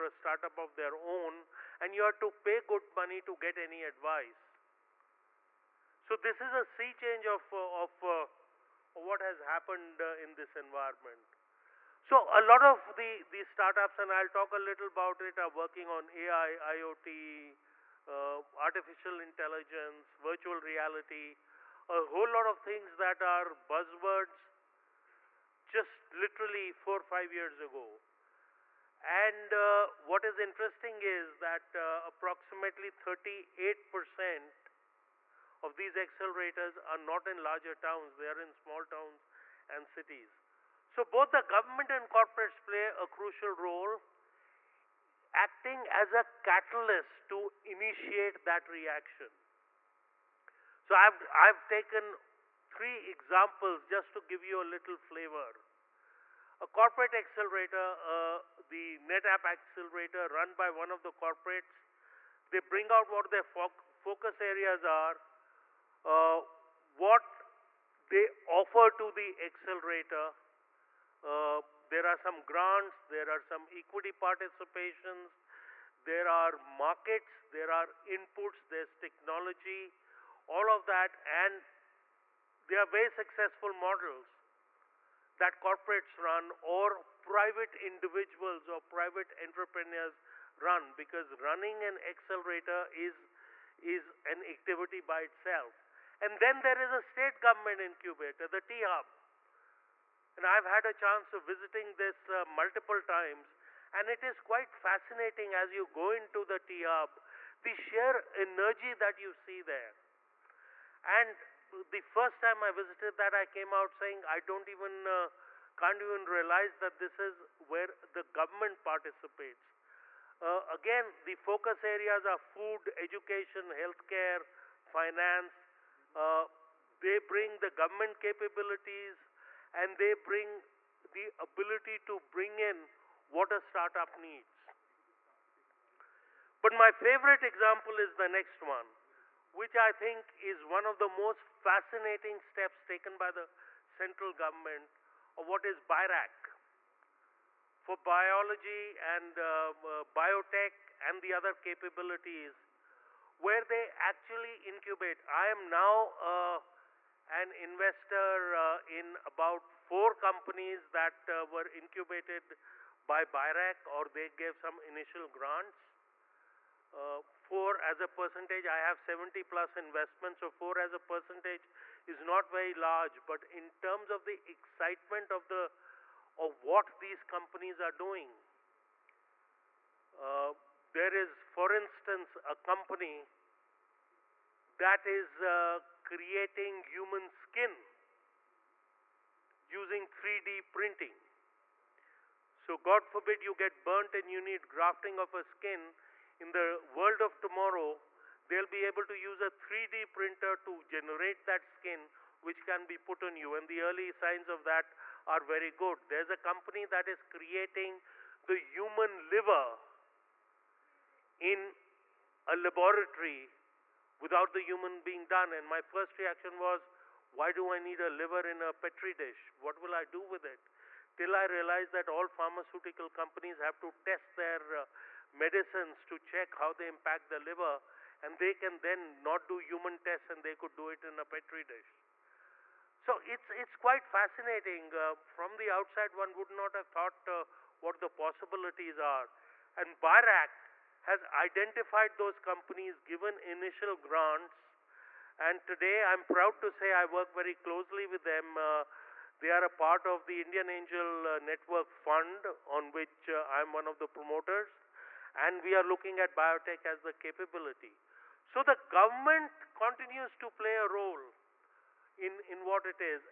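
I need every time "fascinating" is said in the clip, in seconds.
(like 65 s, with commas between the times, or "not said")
104 s, 141 s, 234 s.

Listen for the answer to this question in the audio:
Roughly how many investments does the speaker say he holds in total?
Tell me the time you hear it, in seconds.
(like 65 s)
168 s.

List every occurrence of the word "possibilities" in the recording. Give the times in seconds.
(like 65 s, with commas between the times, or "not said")
238 s.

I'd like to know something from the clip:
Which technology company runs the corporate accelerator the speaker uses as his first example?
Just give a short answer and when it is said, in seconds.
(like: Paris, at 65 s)
NetApp, at 59 s.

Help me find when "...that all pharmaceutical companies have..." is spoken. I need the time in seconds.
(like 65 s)
221 s.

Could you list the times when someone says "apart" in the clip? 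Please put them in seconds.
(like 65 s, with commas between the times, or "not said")
not said.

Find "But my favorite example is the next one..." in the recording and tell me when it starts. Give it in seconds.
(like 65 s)
136 s.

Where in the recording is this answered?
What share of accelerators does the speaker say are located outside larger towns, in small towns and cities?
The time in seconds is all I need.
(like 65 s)
33 s.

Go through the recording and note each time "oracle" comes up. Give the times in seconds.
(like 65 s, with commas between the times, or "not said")
not said.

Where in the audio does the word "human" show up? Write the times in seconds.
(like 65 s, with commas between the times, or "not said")
186 s, 208 s, 214 s, 229 s.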